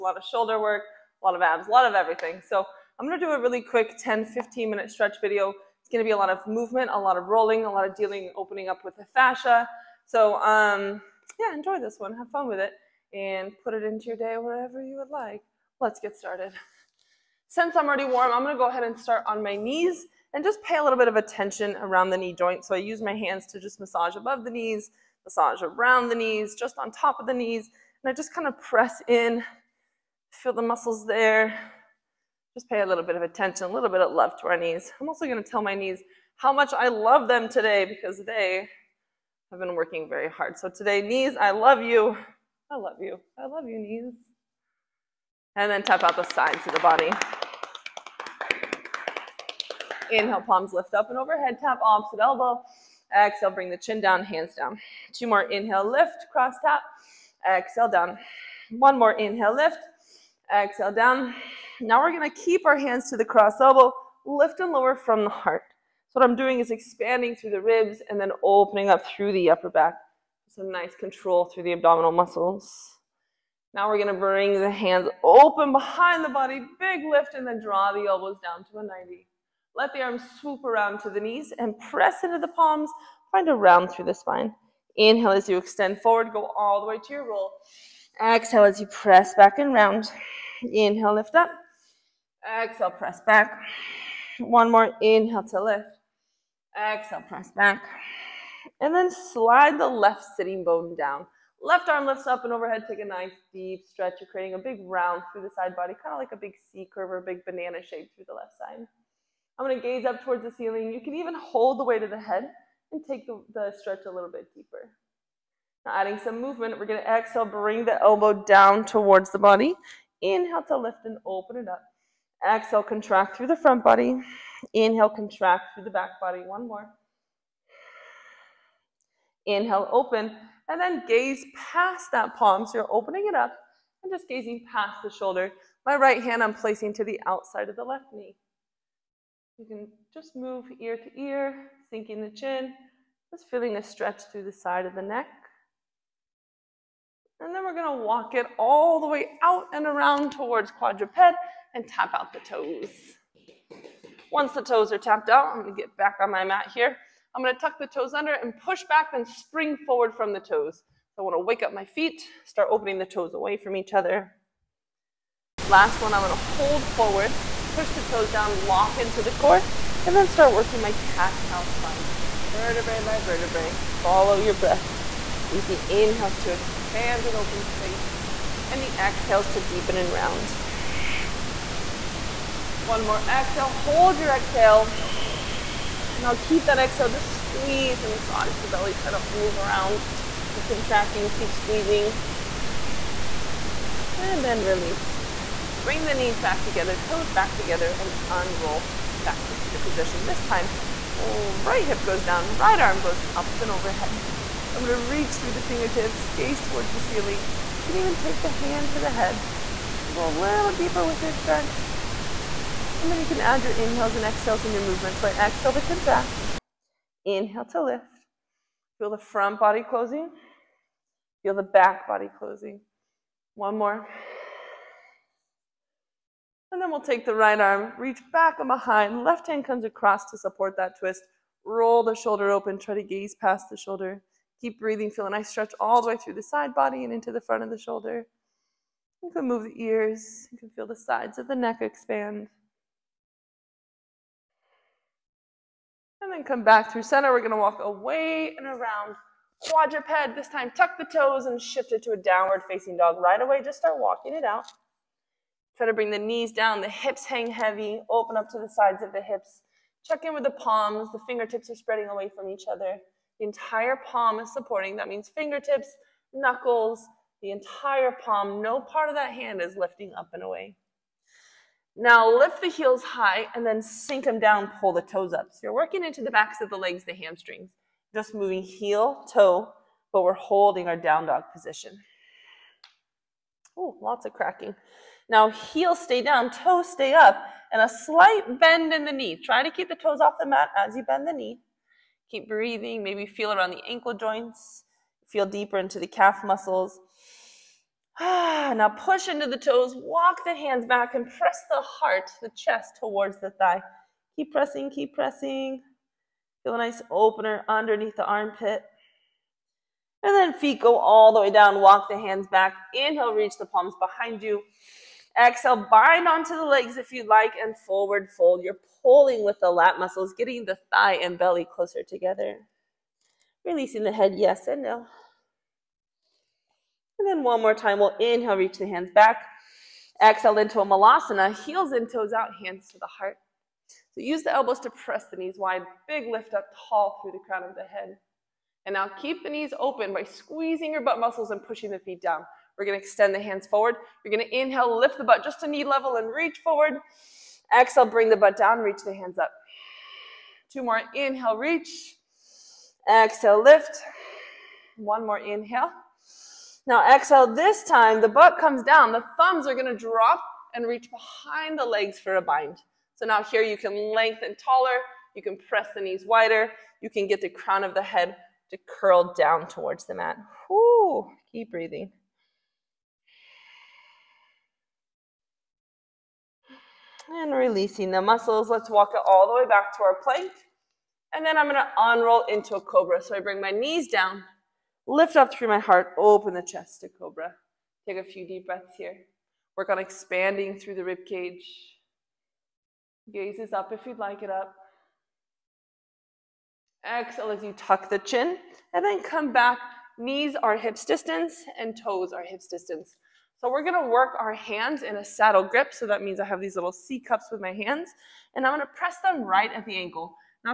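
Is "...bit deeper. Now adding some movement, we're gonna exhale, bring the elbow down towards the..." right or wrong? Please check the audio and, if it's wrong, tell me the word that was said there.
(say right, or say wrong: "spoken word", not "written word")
right.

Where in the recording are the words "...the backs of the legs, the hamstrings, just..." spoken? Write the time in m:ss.
4:36.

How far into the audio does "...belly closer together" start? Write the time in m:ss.
5:21.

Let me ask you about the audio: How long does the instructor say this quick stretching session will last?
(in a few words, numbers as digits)
10-15 minutes.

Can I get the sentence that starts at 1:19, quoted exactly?
Let the arms swoop around to the knees and press into the palms.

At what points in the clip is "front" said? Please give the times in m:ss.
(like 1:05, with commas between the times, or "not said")
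2:03, 3:39, 3:57.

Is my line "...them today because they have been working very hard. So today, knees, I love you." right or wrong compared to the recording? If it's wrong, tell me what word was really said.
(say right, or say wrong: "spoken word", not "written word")
right.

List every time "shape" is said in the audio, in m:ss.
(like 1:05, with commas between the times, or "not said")
1:47.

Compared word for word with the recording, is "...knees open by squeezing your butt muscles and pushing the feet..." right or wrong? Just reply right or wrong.
right.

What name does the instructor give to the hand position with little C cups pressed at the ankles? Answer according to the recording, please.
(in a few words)
Saddle grip.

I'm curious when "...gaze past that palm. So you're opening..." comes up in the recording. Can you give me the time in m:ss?
2:11.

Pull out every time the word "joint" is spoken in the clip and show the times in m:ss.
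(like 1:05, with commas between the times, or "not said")
0:22, 4:54.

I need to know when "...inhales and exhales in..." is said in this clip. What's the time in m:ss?
3:33.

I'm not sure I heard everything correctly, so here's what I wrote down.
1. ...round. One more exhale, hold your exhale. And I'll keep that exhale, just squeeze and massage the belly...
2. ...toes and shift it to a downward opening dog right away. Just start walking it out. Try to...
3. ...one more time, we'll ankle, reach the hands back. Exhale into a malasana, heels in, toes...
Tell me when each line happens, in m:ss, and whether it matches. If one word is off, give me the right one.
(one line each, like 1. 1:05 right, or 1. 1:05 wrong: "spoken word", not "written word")
1. 3:00 right
2. 4:11 wrong: "facing", not "opening"
3. 5:27 wrong: "inhale", not "ankle".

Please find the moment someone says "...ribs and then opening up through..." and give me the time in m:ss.
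1:07.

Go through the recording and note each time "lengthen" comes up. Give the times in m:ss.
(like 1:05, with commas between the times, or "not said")
6:04.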